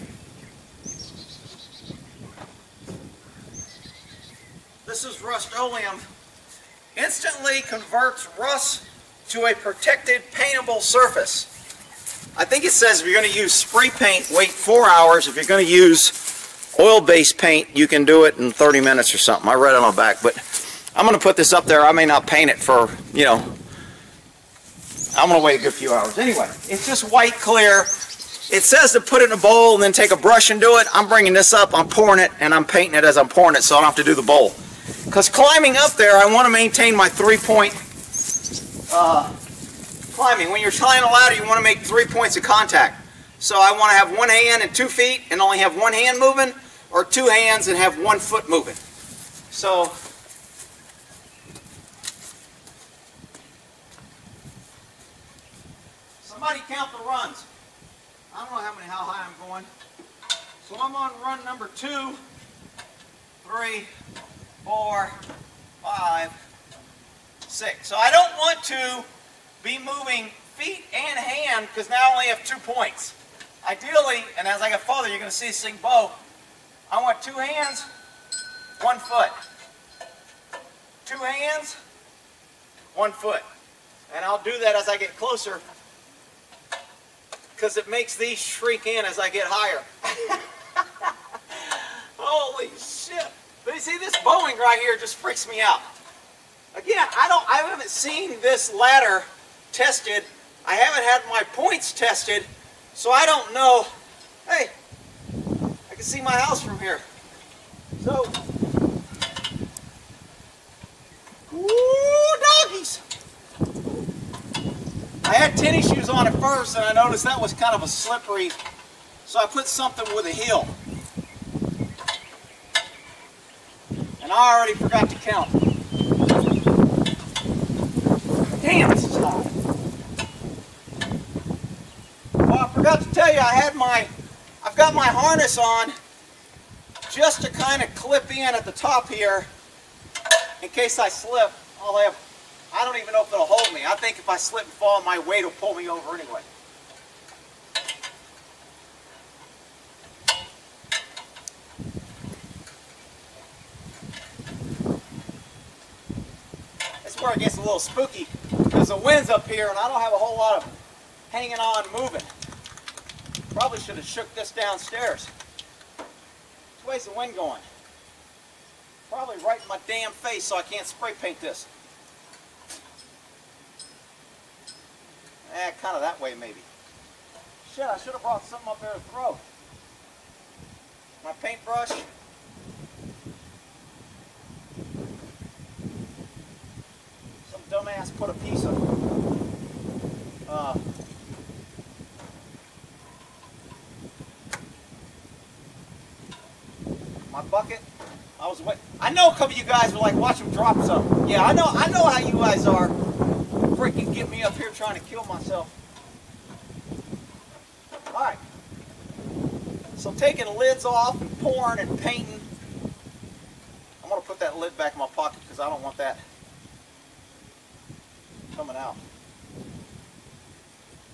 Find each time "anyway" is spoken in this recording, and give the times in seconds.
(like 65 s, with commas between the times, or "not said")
26 s, 146 s.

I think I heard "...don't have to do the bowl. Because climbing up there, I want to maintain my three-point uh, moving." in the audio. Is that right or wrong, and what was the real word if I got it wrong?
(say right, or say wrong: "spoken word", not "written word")
wrong: "climbing", not "moving".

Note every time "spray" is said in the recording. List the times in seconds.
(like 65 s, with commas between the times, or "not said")
13 s, 170 s.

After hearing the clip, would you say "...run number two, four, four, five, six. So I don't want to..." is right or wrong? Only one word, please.
wrong.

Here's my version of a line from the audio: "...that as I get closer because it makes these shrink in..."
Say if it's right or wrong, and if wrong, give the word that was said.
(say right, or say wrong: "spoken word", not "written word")
right.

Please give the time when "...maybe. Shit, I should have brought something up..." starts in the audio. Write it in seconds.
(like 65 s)
176 s.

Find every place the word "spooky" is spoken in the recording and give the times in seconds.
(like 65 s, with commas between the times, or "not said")
157 s.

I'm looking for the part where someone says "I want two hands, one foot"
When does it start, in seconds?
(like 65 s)
76 s.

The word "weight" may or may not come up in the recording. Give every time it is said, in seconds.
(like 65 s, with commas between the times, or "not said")
145 s.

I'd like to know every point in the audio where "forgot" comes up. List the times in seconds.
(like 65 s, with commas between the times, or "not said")
124 s, 132 s.